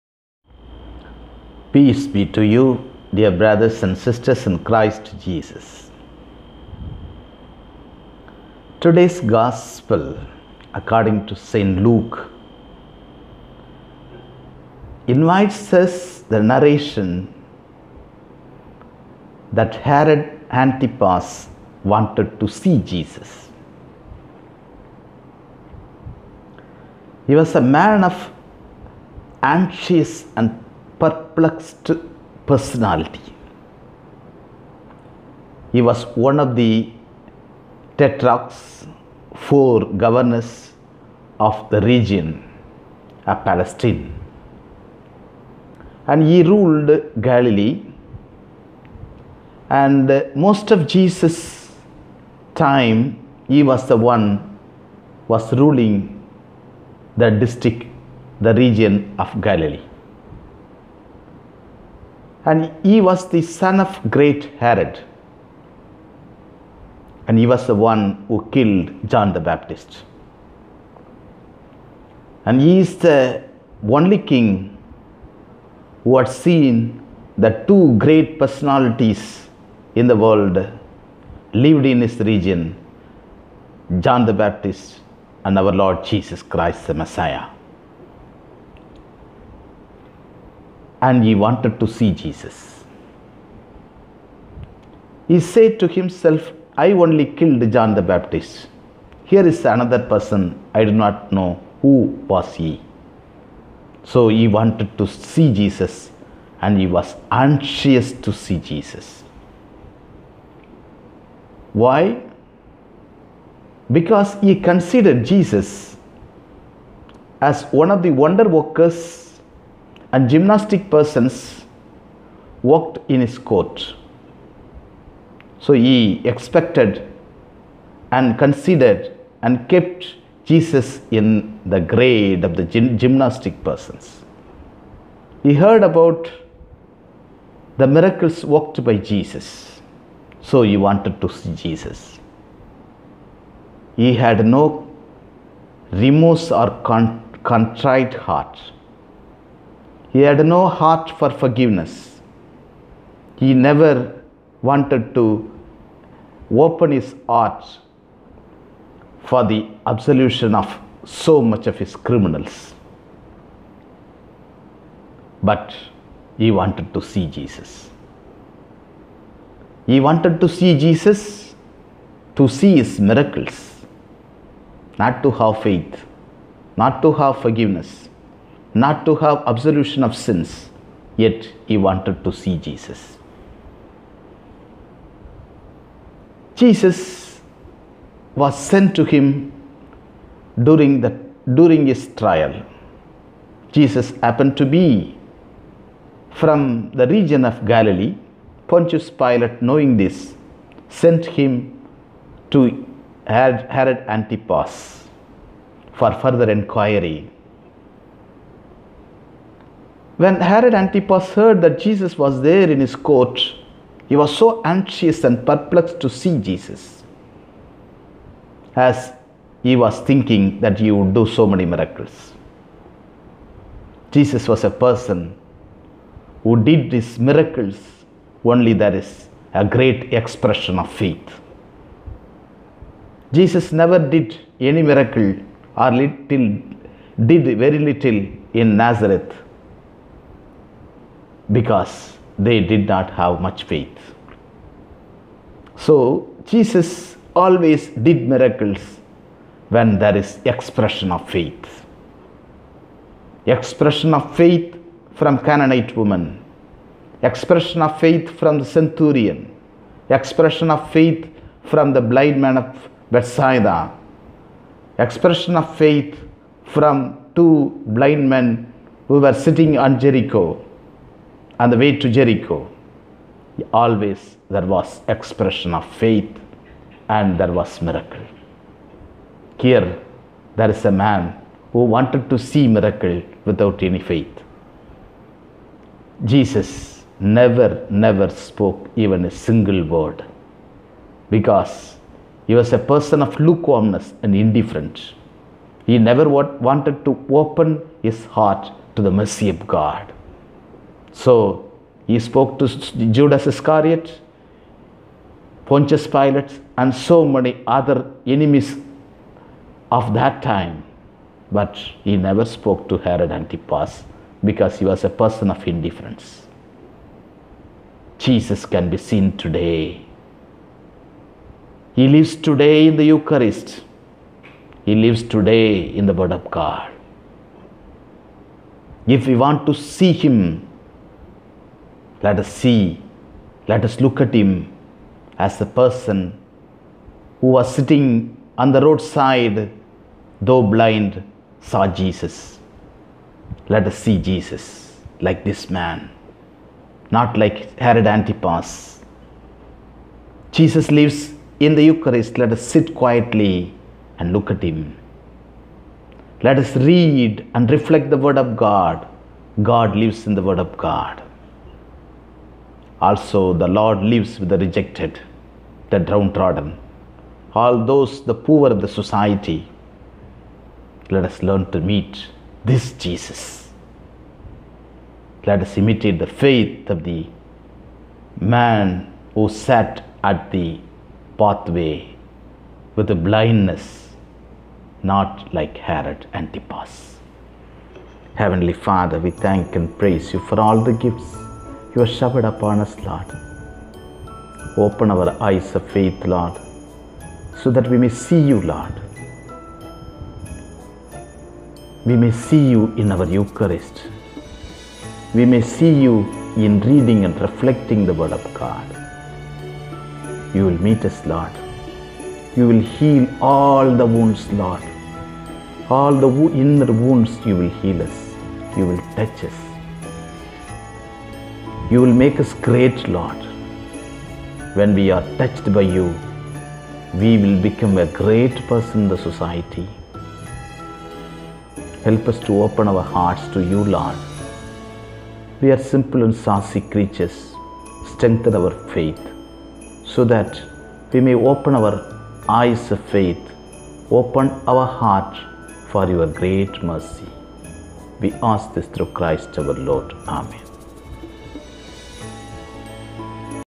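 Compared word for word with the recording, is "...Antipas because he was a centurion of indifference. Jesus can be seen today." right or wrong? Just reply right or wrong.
wrong.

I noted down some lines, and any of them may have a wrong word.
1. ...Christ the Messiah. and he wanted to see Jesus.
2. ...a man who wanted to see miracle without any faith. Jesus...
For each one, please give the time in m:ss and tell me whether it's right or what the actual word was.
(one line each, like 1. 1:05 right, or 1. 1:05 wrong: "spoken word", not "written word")
1. 1:26 right
2. 4:40 right.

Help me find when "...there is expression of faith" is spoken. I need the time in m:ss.
4:09.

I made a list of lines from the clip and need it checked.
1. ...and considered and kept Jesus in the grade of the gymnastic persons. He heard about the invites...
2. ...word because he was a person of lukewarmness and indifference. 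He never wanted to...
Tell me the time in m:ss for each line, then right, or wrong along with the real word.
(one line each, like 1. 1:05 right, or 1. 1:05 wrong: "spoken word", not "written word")
1. 2:08 wrong: "miracles", not "invites"
2. 4:49 right.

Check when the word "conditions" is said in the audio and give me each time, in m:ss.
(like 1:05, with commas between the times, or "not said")
not said.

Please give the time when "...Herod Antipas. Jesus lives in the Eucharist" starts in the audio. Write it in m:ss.
5:47.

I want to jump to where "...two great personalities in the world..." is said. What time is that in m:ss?
1:17.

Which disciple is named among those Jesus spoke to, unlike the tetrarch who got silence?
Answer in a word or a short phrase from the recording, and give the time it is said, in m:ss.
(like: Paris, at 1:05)
Judas Iscariot, at 5:03.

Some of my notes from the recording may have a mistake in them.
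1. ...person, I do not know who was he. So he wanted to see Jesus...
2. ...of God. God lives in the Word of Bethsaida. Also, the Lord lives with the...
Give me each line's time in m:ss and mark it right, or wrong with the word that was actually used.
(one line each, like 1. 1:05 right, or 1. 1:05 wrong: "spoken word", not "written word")
1. 1:40 right
2. 5:58 wrong: "God", not "Bethsaida".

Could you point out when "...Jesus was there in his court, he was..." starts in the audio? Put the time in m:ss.
3:31.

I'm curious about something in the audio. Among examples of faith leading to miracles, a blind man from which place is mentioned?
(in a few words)
Bethsaida.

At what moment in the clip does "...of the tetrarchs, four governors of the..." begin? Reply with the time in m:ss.
0:36.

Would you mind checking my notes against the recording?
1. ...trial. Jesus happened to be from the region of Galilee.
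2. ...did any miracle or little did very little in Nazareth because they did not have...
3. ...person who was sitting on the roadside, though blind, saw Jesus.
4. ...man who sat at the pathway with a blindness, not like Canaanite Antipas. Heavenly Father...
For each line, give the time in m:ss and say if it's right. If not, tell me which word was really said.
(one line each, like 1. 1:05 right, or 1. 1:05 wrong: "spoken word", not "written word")
1. 3:12 right
2. 3:54 right
3. 5:35 right
4. 6:18 wrong: "Herod", not "Canaanite".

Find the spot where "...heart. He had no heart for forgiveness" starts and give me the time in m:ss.
2:28.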